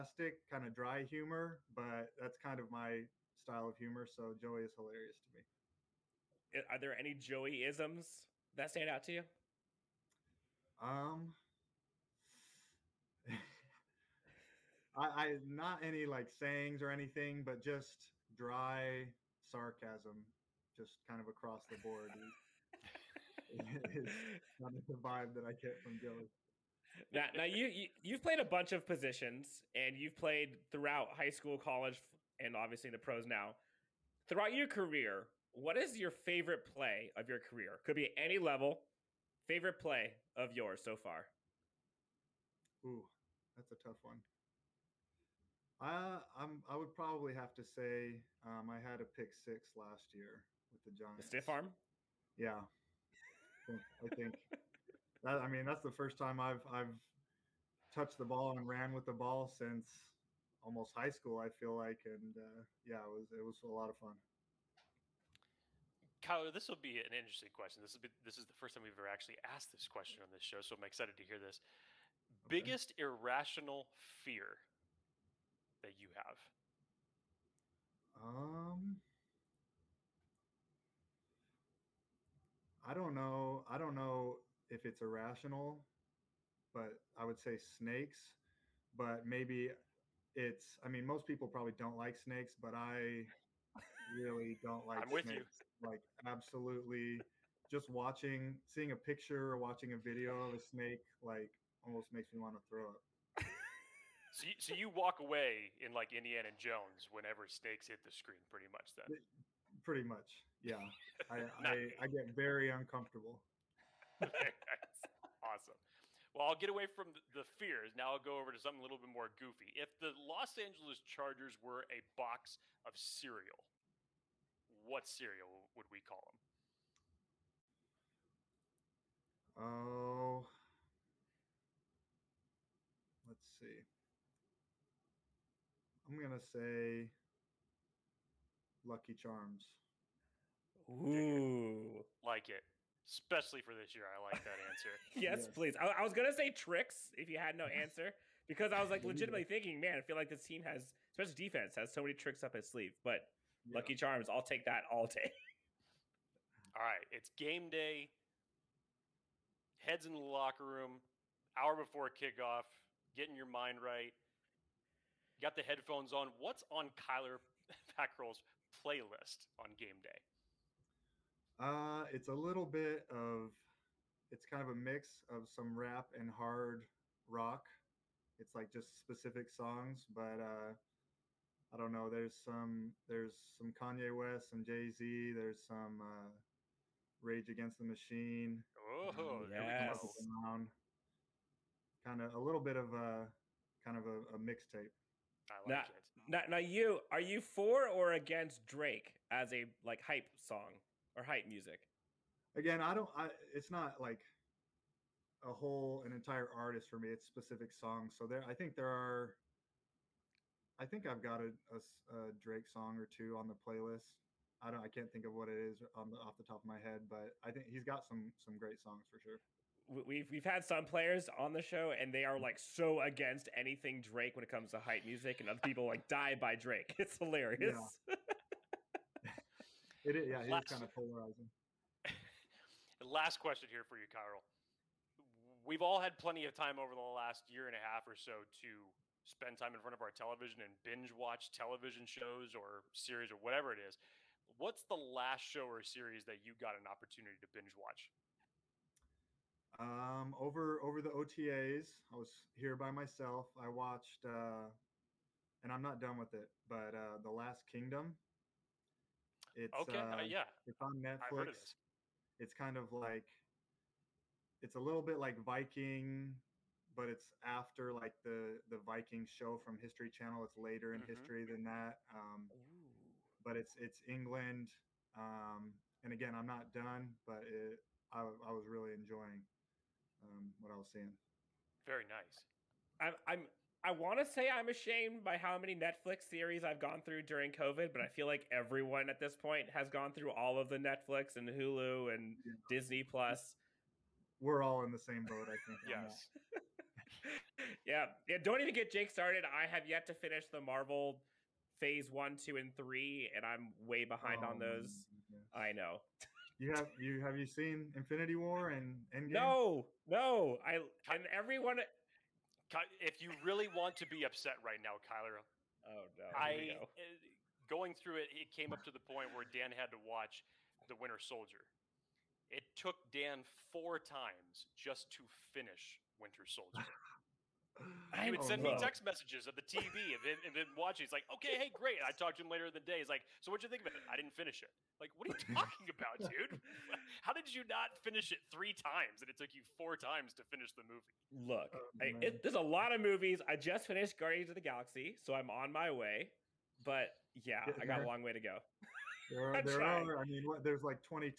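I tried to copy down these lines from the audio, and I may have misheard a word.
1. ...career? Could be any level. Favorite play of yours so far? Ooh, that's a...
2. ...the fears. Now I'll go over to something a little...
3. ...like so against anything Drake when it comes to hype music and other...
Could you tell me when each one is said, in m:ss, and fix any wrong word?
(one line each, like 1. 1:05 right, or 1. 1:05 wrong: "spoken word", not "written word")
1. 0:37 right
2. 1:57 right
3. 3:42 right.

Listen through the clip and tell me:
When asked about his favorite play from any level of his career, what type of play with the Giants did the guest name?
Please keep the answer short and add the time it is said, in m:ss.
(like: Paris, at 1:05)
Pick six, at 0:49.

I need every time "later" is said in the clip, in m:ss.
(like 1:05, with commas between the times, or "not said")
4:30, 5:32.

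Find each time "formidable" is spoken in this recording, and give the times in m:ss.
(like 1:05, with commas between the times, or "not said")
not said.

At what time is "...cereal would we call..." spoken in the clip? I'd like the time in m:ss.
2:05.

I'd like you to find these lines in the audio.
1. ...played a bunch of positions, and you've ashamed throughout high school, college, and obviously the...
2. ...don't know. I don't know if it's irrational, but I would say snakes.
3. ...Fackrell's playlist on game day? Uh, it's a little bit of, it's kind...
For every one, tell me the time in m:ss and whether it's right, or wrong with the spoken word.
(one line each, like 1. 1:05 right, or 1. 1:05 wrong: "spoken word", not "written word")
1. 0:28 wrong: "played", not "ashamed"
2. 1:22 right
3. 2:47 right.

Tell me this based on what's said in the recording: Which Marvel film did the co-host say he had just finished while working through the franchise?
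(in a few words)
Guardians of the Galaxy.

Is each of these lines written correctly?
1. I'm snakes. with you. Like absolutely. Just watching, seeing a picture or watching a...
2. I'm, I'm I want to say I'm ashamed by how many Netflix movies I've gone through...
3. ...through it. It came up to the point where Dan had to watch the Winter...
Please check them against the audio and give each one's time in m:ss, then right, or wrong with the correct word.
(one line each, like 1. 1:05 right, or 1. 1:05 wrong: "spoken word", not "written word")
1. 1:35 right
2. 4:42 wrong: "series", not "movies"
3. 5:17 right.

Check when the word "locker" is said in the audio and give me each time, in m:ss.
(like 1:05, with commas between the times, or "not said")
2:40.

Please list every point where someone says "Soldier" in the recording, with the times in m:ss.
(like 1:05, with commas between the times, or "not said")
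5:21, 5:26.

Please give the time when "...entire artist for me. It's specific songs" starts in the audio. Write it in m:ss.
3:26.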